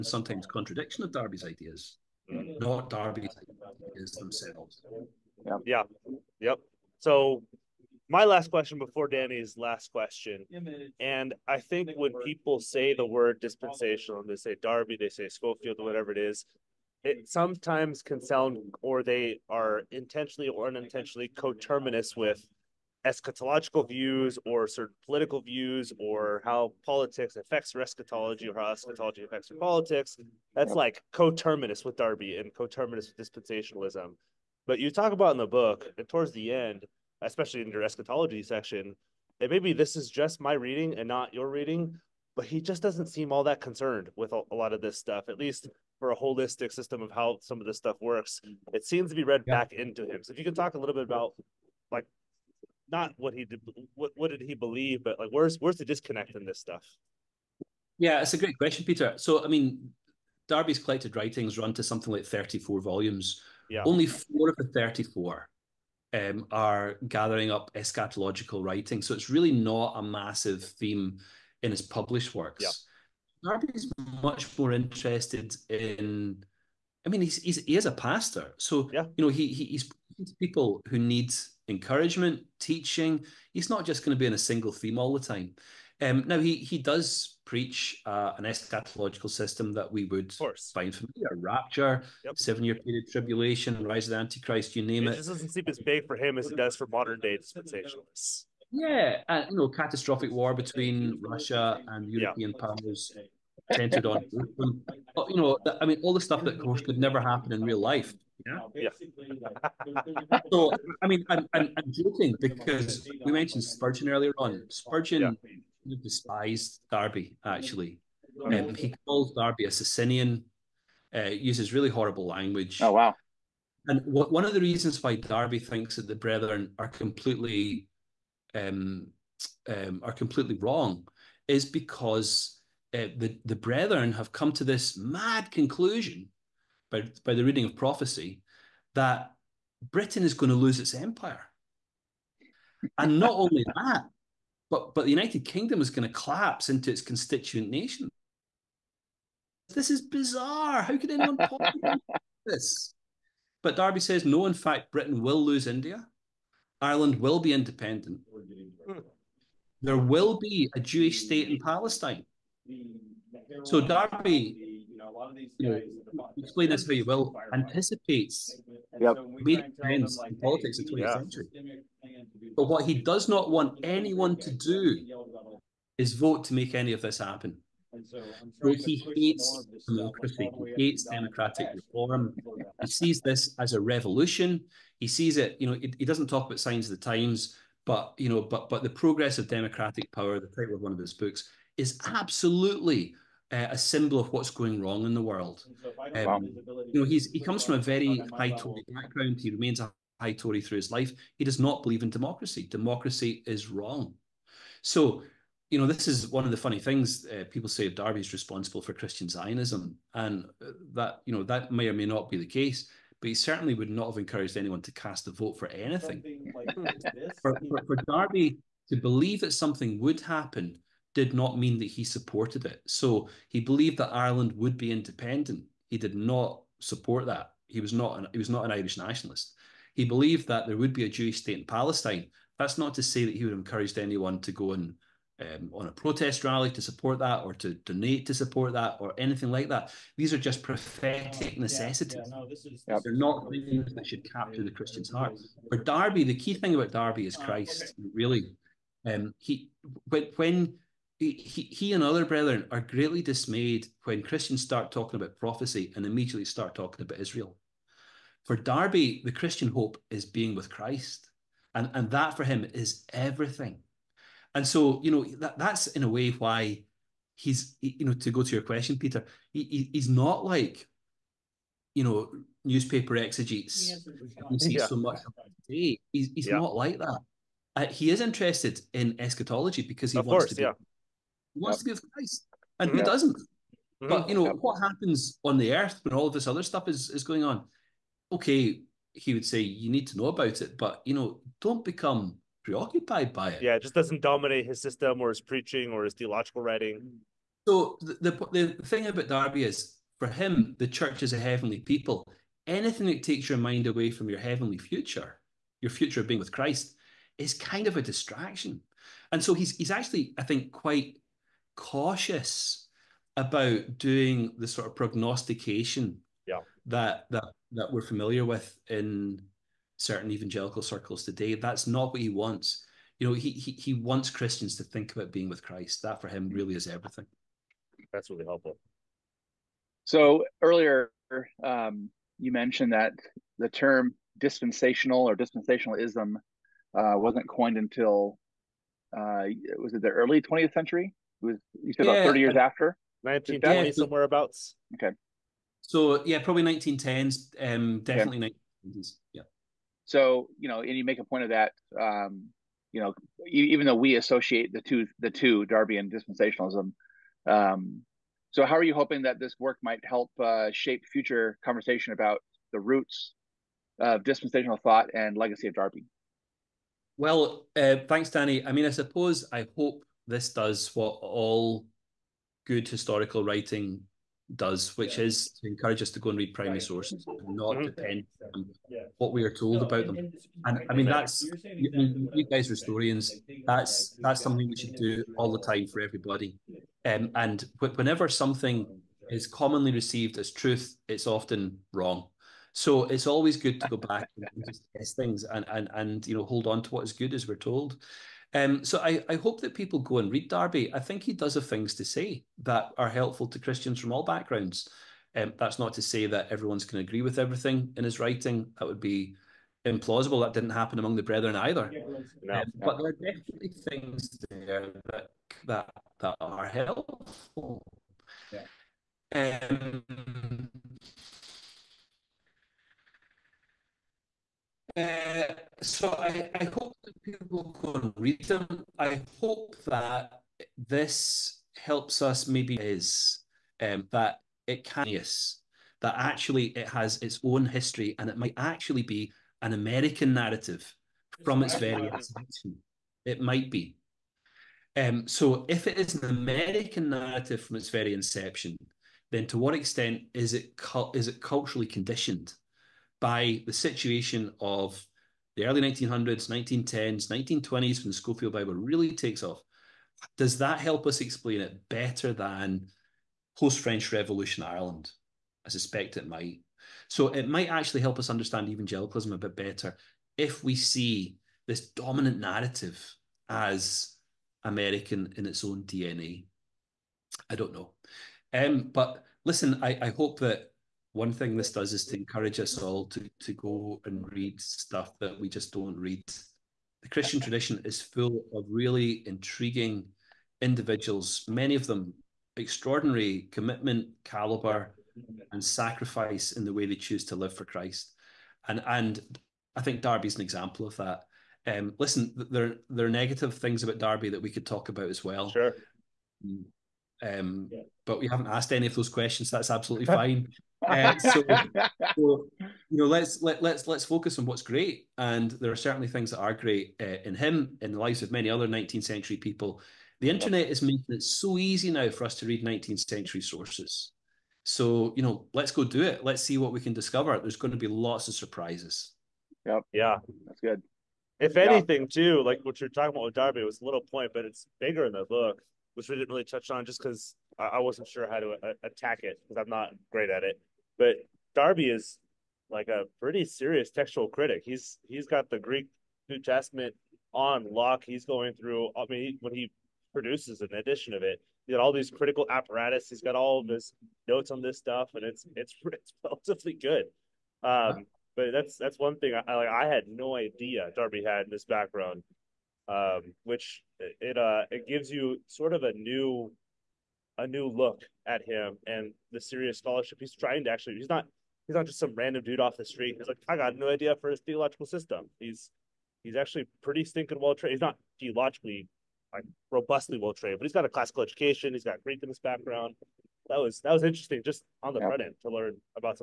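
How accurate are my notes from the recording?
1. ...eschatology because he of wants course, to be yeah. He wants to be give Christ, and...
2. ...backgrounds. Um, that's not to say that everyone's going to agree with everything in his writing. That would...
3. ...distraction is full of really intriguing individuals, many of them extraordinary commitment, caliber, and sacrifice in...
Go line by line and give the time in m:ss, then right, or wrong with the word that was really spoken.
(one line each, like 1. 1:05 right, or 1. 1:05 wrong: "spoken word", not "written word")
1. 4:39 right
2. 6:44 right
3. 8:07 wrong: "tradition", not "distraction".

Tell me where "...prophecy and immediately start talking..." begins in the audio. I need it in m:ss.
4:15.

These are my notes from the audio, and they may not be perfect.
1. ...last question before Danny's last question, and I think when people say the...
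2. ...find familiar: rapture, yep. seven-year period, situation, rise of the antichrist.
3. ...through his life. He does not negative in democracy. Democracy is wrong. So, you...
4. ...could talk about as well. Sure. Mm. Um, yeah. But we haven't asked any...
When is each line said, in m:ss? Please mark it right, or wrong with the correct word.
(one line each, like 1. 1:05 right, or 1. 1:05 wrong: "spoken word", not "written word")
1. 0:08 right
2. 1:30 wrong: "tribulation", not "situation"
3. 3:20 wrong: "believe", not "negative"
4. 8:24 right.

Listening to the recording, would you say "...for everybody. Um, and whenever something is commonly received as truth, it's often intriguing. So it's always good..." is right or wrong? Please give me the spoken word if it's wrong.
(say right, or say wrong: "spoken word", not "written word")
wrong: "wrong", not "intriguing".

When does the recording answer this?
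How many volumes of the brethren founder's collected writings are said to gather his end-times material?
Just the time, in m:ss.
1:03.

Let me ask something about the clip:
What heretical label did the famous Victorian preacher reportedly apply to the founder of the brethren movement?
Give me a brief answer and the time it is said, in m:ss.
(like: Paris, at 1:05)
Socinian, at 1:59.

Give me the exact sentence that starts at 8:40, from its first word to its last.
The internet is making it so easy now for us to read 19th century sources.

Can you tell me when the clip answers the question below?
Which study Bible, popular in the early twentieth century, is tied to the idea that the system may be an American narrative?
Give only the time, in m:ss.
7:38.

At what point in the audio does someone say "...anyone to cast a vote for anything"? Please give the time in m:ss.
3:34.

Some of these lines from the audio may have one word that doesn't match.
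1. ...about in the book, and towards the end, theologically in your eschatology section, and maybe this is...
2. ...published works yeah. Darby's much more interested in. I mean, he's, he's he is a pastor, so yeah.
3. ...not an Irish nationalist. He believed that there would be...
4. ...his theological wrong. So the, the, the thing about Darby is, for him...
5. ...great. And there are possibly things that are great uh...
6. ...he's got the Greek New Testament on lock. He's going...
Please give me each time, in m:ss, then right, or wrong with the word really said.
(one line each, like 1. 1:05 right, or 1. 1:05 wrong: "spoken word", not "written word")
1. 0:35 wrong: "especially", not "theologically"
2. 1:11 right
3. 3:48 right
4. 4:56 wrong: "writing", not "wrong"
5. 8:34 wrong: "certainly", not "possibly"
6. 9:05 right.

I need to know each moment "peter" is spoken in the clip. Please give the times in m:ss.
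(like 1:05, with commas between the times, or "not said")
0:58, 4:28.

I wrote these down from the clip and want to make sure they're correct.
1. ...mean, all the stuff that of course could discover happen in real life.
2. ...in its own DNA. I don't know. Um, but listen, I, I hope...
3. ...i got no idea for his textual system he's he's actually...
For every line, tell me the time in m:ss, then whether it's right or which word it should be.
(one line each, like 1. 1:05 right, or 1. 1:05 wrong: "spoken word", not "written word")
1. 1:45 wrong: "never", not "discover"
2. 7:55 right
3. 9:33 wrong: "theological", not "textual".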